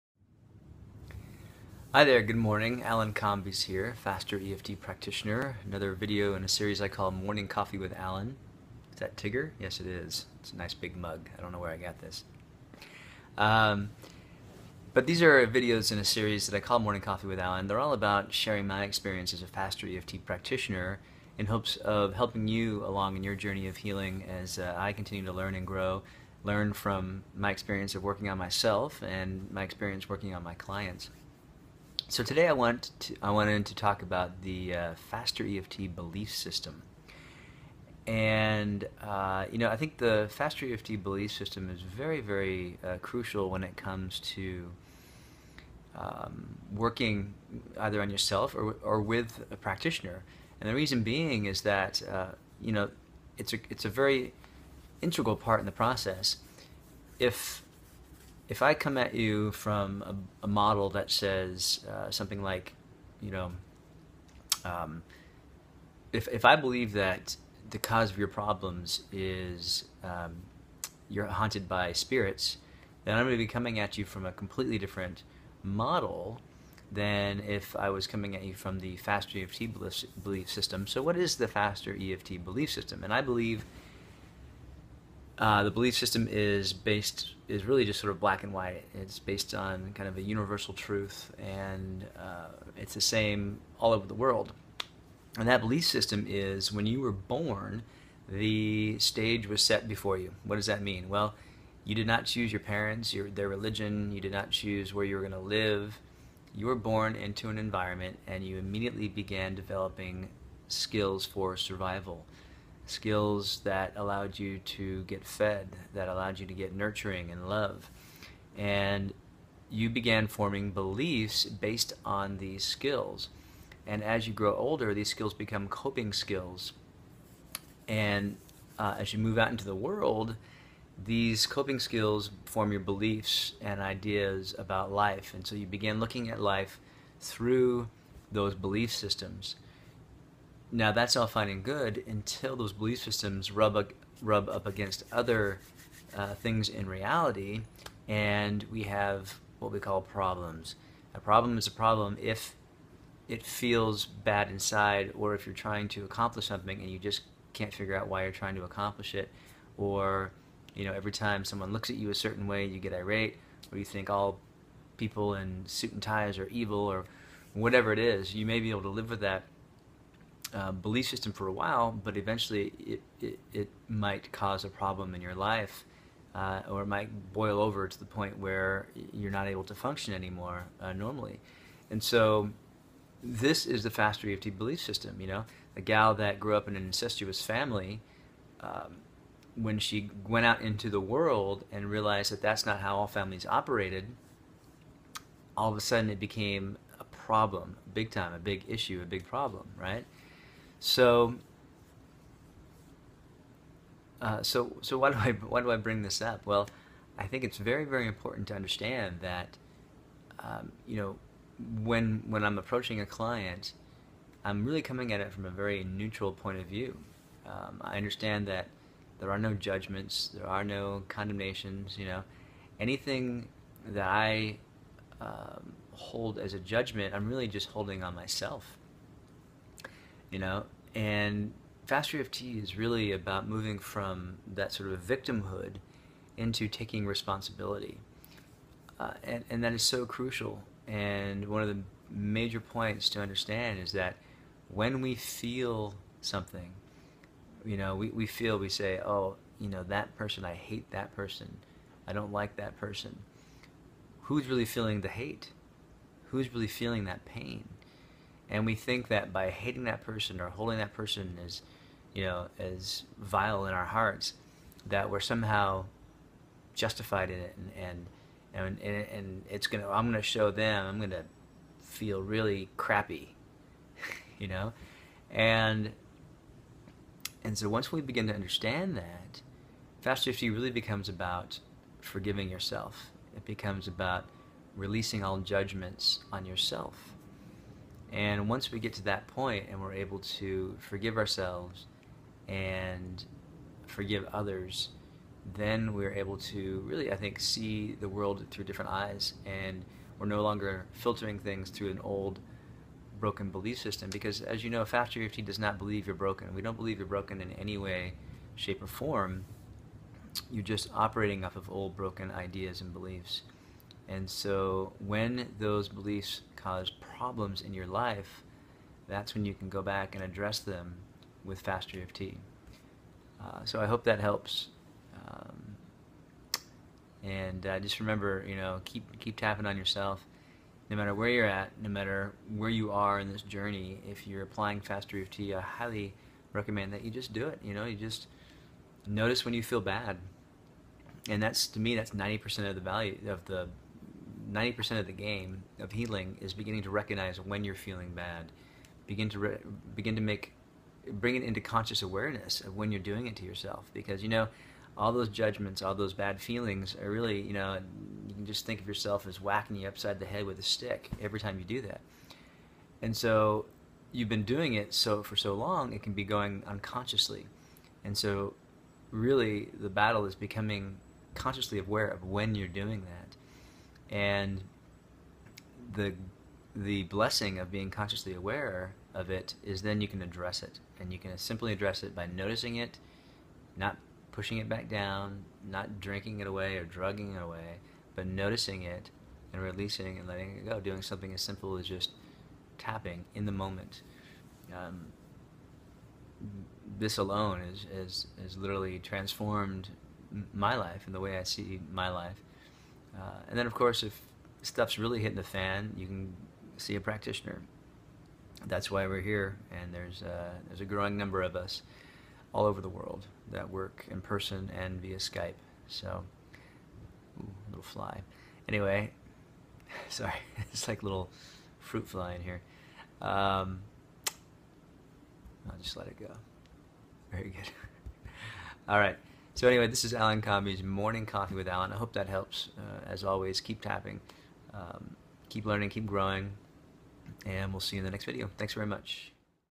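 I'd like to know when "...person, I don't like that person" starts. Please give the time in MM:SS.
04:11.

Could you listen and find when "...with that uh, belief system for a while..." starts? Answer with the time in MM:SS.
02:49.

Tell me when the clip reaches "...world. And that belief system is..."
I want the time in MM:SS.
01:34.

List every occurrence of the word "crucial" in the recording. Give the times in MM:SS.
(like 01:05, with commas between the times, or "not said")
00:43, 04:00.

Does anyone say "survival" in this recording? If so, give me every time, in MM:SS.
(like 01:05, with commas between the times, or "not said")
01:51.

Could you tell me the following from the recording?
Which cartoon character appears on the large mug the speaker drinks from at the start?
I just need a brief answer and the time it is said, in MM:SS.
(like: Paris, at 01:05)
Tigger, at 00:09.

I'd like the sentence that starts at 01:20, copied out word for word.
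So what is the faster EFT belief system?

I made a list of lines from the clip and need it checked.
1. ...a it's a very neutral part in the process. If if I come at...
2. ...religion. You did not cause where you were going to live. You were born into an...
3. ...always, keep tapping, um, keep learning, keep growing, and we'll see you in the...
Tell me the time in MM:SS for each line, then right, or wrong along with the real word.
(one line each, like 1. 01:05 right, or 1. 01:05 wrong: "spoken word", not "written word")
1. 00:53 wrong: "integral", not "neutral"
2. 01:43 wrong: "choose", not "cause"
3. 07:13 right.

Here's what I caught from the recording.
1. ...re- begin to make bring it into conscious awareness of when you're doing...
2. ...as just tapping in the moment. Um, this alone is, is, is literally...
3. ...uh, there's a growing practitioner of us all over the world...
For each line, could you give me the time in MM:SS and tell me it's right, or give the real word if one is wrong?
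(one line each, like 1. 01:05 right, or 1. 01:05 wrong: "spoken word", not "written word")
1. 05:49 right
2. 06:31 right
3. 06:50 wrong: "number", not "practitioner".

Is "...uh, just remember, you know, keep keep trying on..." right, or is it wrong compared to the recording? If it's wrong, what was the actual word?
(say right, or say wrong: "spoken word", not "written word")
wrong: "tapping", not "trying".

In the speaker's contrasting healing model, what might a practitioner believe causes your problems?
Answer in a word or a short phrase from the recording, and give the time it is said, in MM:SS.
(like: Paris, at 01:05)
haunted by spirits, at 01:11.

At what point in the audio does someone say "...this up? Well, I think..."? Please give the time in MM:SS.
03:26.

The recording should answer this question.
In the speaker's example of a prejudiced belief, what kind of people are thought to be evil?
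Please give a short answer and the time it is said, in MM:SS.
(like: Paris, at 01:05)
people in suit and ties, at 02:44.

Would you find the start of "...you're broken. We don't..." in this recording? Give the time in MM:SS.
05:06.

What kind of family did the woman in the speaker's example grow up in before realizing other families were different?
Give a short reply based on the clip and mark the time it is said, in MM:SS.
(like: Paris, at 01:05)
incestuous, at 03:06.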